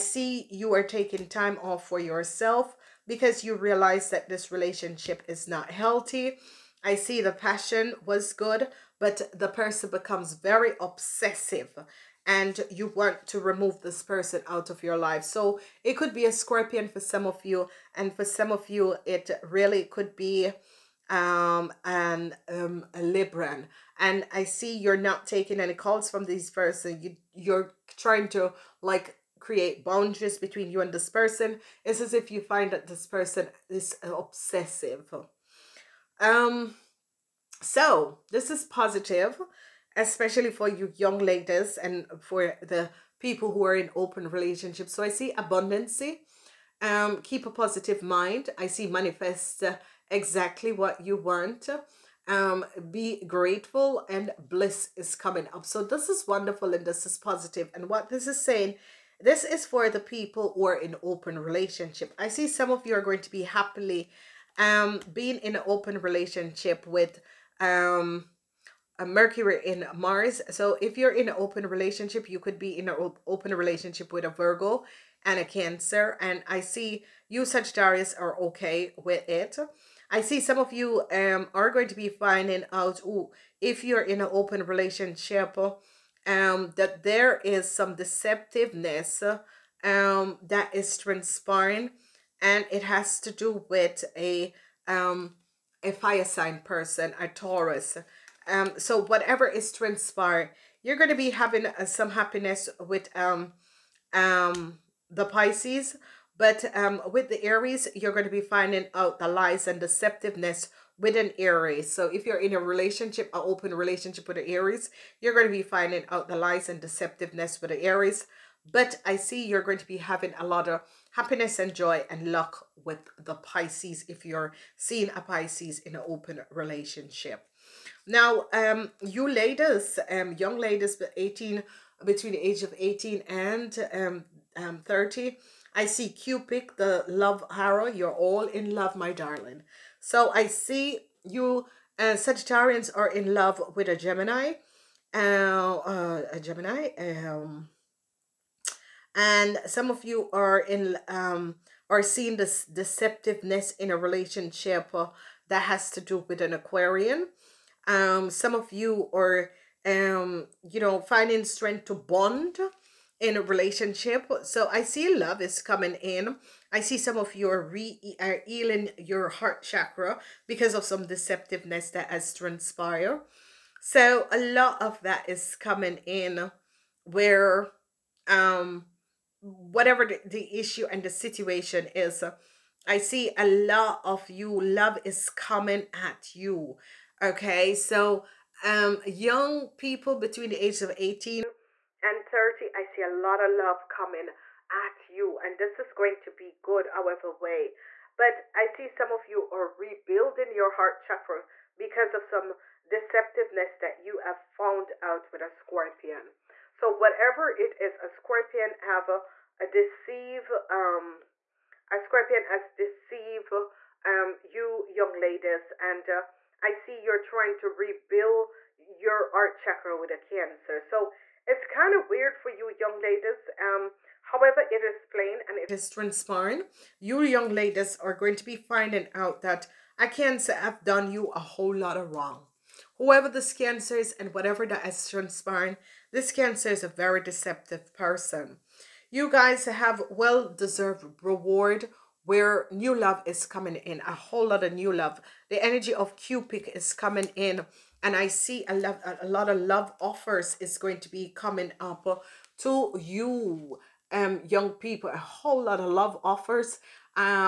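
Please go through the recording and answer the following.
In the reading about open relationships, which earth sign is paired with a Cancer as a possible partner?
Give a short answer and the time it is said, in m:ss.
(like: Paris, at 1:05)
Virgo, at 1:14.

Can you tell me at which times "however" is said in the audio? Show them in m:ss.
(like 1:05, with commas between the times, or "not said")
3:16, 3:44.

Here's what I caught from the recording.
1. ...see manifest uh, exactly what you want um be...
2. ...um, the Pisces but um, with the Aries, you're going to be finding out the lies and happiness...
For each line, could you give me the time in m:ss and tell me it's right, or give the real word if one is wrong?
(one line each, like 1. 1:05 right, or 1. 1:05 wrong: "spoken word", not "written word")
1. 0:48 right
2. 1:44 wrong: "deceptiveness", not "happiness".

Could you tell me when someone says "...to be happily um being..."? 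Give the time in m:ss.
1:03.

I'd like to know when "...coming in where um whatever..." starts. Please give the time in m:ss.
2:55.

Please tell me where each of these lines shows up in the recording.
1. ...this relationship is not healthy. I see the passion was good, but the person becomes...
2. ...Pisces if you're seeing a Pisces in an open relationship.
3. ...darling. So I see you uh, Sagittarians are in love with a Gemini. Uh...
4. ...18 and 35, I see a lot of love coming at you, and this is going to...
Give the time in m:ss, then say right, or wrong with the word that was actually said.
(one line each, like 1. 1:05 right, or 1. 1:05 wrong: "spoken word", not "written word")
1. 0:04 right
2. 2:03 right
3. 2:19 right
4. 3:10 wrong: "30", not "35".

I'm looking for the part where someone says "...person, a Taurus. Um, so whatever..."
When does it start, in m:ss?
1:36.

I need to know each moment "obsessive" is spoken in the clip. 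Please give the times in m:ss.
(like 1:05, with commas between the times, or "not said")
0:10, 0:34.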